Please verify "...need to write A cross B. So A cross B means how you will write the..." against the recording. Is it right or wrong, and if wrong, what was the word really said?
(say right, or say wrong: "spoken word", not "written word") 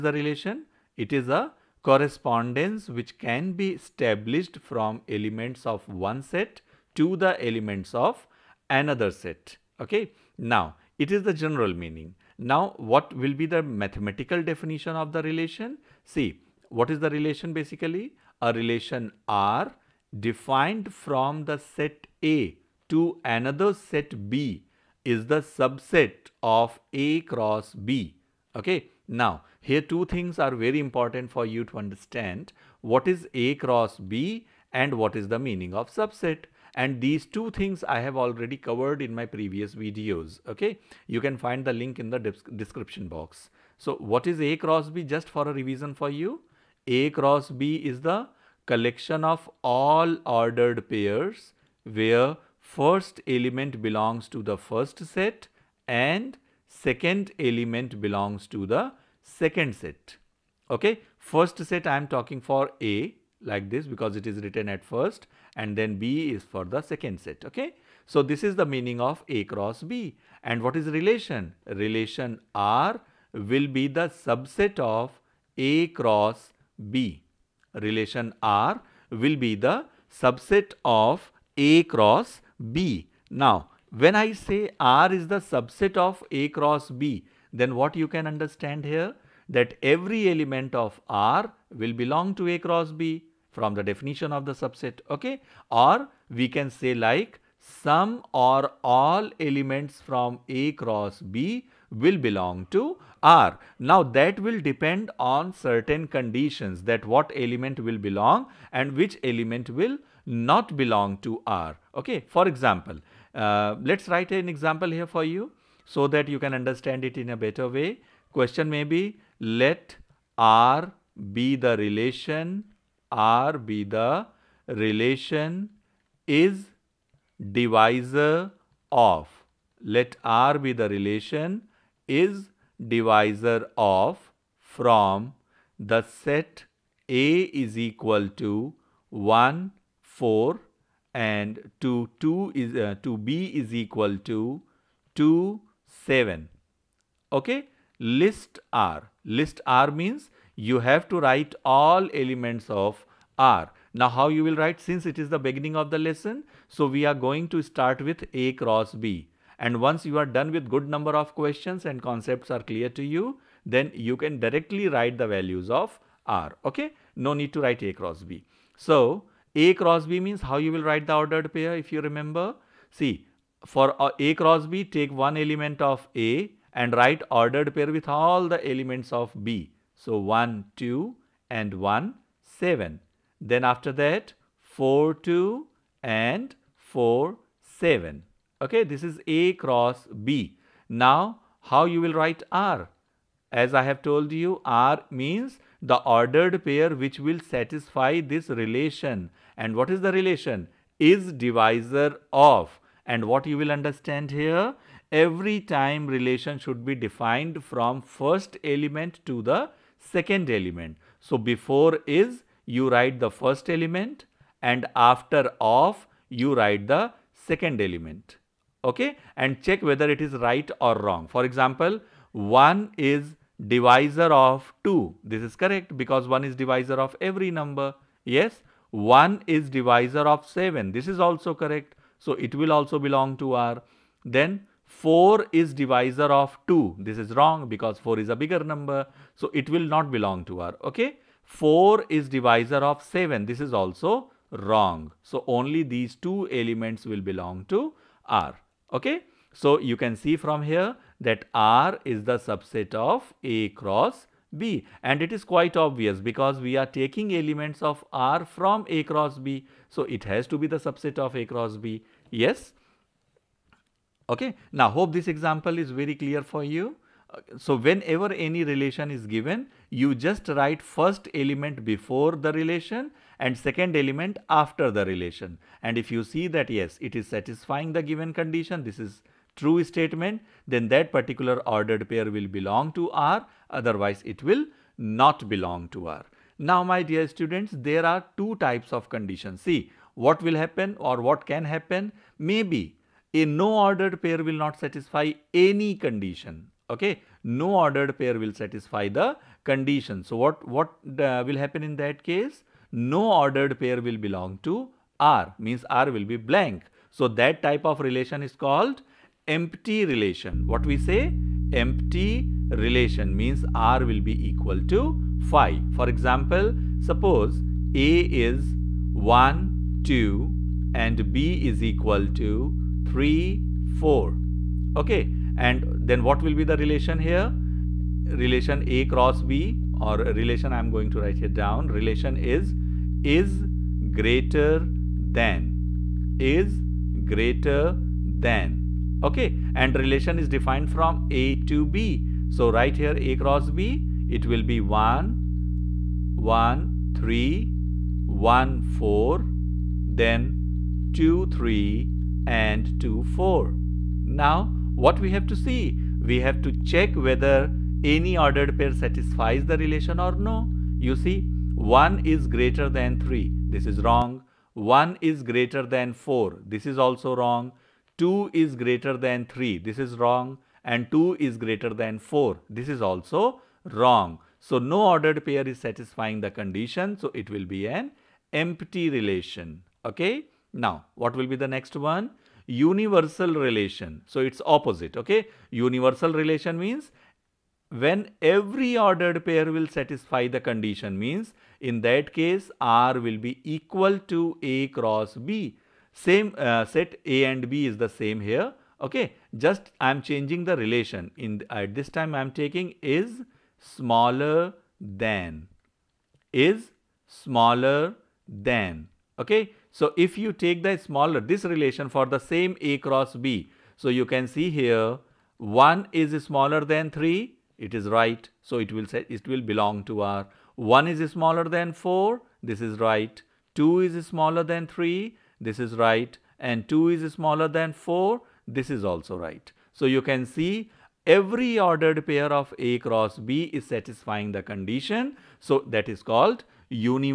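right.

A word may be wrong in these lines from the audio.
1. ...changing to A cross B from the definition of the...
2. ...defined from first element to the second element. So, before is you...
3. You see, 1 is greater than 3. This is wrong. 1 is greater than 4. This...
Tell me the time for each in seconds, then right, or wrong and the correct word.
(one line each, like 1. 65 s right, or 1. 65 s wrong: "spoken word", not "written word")
1. 91 s wrong: "belong", not "changing"
2. 206 s right
3. 360 s right.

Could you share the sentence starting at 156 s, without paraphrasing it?
So we are going to start with A cross B.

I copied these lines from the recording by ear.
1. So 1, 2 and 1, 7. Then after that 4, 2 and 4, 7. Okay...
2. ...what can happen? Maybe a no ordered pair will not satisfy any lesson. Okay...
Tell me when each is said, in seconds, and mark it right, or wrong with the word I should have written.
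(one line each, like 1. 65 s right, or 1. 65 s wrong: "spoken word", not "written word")
1. 180 s right
2. 291 s wrong: "condition", not "lesson".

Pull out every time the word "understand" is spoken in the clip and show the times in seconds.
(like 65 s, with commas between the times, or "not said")
31 s, 88 s, 116 s, 203 s.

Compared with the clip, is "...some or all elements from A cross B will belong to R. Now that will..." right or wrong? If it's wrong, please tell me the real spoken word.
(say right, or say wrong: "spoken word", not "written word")
right.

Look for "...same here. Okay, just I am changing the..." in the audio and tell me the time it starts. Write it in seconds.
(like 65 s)
398 s.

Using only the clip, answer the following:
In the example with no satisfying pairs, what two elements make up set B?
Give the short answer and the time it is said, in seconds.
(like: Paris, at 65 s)
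3 and 4, at 321 s.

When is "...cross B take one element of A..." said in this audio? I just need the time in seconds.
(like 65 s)
174 s.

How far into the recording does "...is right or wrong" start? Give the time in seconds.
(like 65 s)
220 s.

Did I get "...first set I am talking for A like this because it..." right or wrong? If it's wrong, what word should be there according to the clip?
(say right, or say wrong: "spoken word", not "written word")
right.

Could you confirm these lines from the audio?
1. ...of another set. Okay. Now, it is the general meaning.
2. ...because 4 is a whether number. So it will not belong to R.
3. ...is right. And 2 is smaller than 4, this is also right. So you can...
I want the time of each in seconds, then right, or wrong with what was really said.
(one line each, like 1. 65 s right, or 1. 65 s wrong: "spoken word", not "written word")
1. 7 s right
2. 237 s wrong: "bigger", not "whether"
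3. 425 s right.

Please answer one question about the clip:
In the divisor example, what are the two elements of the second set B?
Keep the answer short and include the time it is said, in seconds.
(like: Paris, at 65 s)
2 and 7, at 143 s.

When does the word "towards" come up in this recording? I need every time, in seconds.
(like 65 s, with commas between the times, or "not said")
not said.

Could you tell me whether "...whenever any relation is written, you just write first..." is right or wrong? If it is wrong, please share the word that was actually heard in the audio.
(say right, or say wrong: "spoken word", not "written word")
wrong: "given", not "written".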